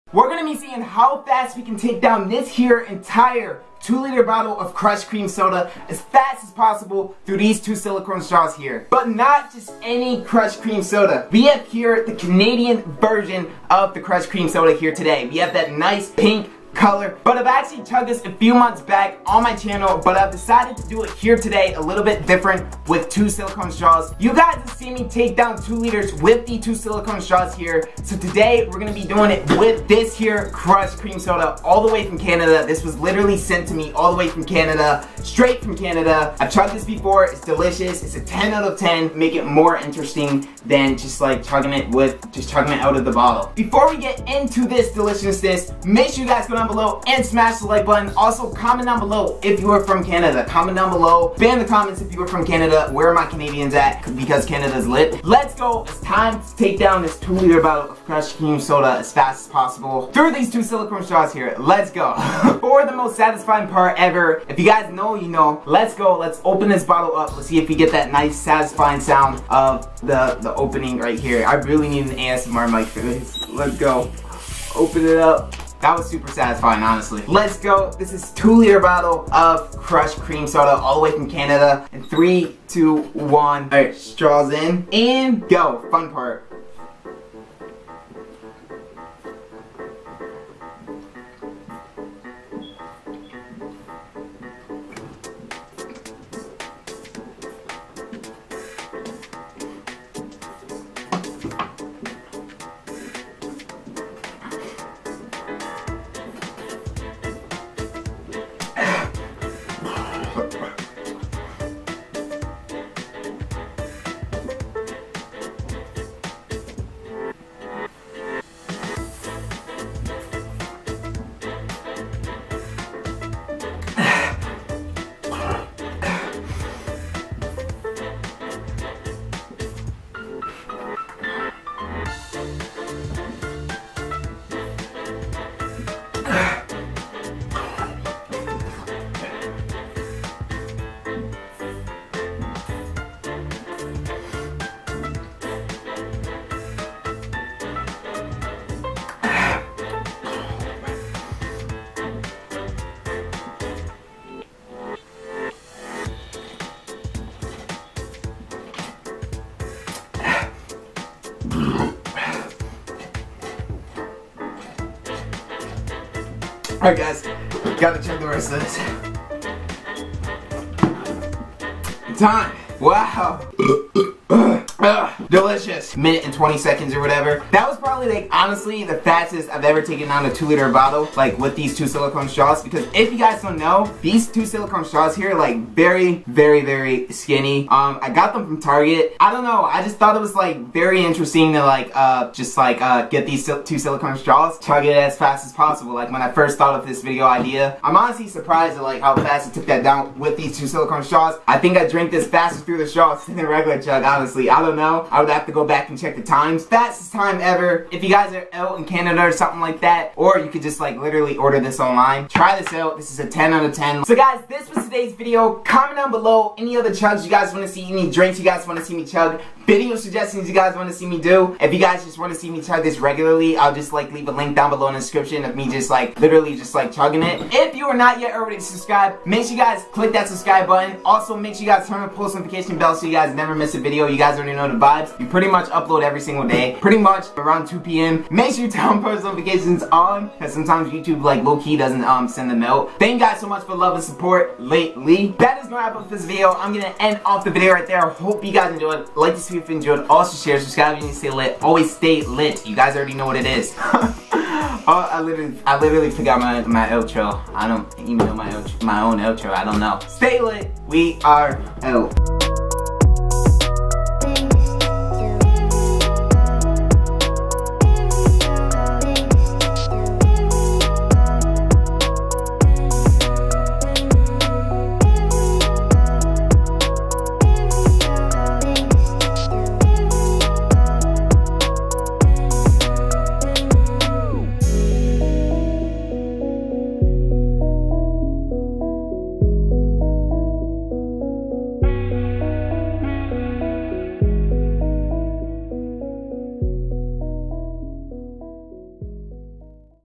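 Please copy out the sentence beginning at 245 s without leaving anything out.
That is gonna wrap up this video.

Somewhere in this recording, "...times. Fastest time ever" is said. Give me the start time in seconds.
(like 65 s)
206 s.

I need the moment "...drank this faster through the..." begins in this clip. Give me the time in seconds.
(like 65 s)
201 s.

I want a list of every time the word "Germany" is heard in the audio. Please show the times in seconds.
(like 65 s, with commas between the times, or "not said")
not said.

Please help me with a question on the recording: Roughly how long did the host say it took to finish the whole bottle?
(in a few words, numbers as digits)
A minute and 20 seconds.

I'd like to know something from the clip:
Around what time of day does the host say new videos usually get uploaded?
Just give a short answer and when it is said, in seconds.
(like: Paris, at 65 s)
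2 p.m., at 237 s.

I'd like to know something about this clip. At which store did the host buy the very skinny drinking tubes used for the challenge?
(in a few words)
Target.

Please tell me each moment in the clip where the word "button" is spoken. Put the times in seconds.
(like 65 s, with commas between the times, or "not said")
47 s, 230 s.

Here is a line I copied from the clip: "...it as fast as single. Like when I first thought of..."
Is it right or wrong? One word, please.
wrong.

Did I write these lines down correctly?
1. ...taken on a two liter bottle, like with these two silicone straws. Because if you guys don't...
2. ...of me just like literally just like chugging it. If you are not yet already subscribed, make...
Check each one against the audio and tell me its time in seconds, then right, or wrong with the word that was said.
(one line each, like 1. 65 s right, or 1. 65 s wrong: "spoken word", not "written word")
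1. 179 s right
2. 225 s right.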